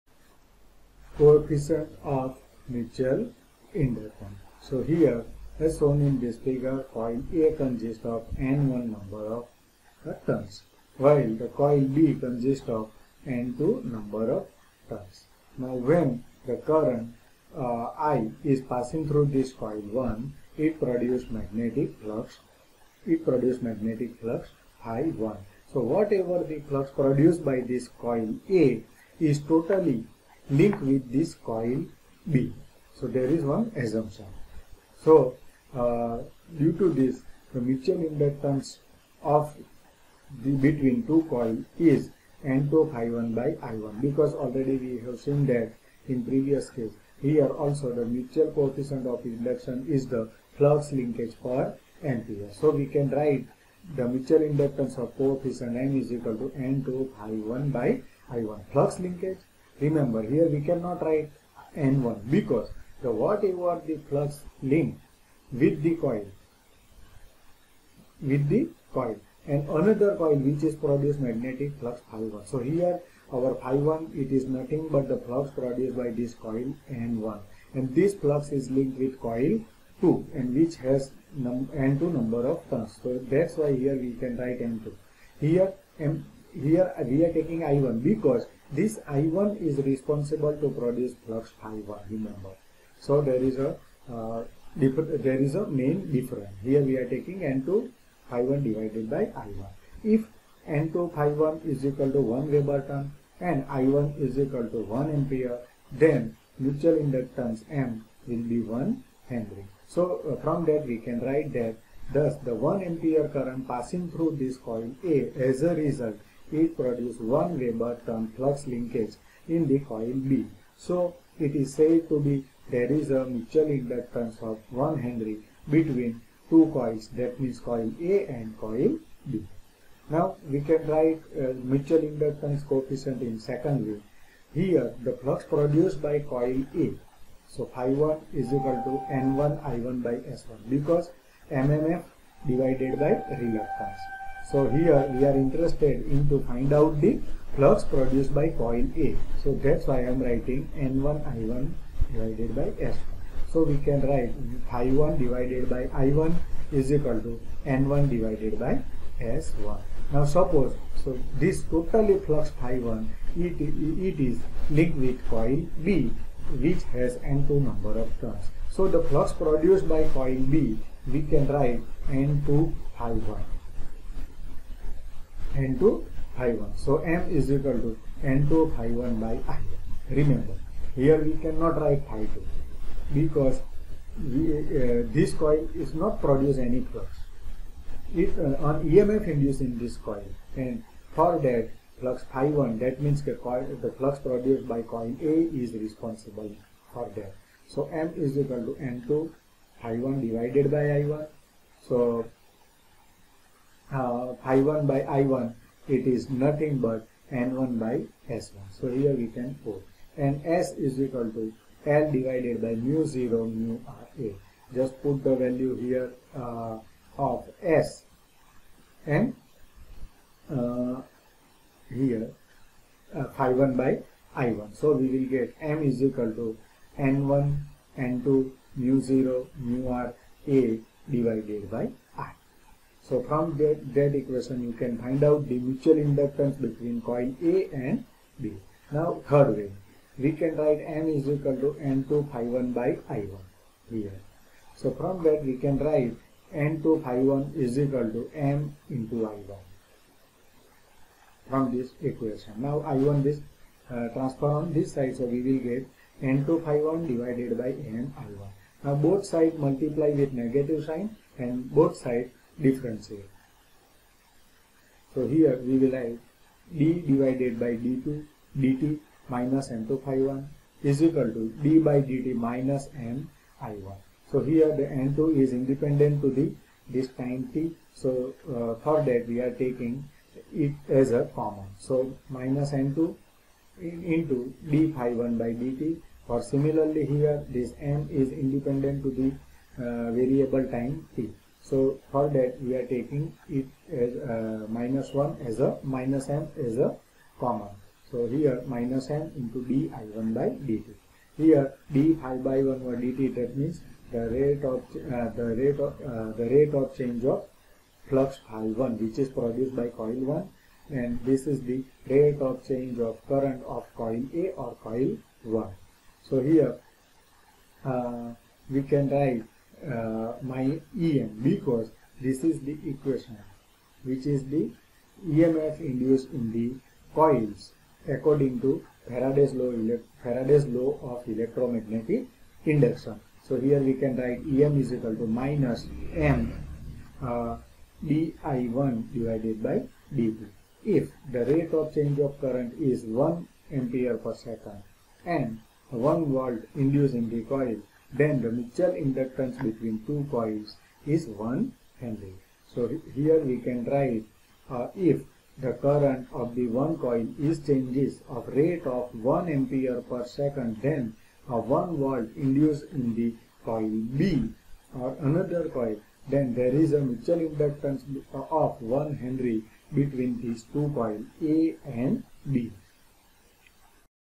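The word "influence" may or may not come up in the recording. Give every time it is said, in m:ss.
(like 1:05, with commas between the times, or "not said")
not said.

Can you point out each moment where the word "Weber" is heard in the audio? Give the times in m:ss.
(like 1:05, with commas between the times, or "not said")
1:42, 1:57.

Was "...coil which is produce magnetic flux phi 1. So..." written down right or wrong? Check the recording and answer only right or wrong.
right.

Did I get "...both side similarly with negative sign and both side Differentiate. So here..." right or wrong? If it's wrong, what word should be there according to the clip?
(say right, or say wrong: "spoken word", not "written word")
wrong: "multiply", not "similarly".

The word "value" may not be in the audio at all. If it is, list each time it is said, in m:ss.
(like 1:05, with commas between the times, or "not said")
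3:35.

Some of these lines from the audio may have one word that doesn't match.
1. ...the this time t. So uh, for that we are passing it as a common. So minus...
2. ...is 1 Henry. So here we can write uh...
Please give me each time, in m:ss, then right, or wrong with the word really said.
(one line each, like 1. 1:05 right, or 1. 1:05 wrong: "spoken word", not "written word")
1. 4:36 wrong: "taking", not "passing"
2. 5:51 right.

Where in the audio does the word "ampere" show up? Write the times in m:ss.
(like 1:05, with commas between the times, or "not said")
0:52, 1:45, 1:52, 5:43, 5:59.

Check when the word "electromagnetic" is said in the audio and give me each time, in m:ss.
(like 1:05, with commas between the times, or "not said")
5:31.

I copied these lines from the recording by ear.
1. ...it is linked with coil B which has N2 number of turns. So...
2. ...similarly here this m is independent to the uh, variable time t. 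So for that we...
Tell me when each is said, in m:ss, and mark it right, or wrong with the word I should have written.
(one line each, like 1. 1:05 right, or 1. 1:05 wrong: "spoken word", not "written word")
1. 2:43 right
2. 4:46 right.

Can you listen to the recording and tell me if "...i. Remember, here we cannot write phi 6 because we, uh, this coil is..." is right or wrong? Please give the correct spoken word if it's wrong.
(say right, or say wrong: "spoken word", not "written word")
wrong: "2", not "6".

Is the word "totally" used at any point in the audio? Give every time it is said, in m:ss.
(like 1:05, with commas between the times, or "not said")
0:29, 2:41.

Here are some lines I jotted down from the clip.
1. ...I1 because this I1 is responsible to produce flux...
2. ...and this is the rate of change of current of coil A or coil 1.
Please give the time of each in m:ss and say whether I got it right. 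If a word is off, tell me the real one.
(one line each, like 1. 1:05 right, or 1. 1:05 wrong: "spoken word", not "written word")
1. 1:27 right
2. 5:11 right.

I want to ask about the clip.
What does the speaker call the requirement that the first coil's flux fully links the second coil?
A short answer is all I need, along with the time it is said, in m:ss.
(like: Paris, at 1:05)
one assumption, at 0:33.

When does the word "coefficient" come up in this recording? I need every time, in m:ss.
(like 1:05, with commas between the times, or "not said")
0:01, 0:48, 0:55, 2:12.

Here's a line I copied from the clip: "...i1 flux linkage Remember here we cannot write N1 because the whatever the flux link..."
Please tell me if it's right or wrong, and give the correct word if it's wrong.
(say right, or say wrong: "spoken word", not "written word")
right.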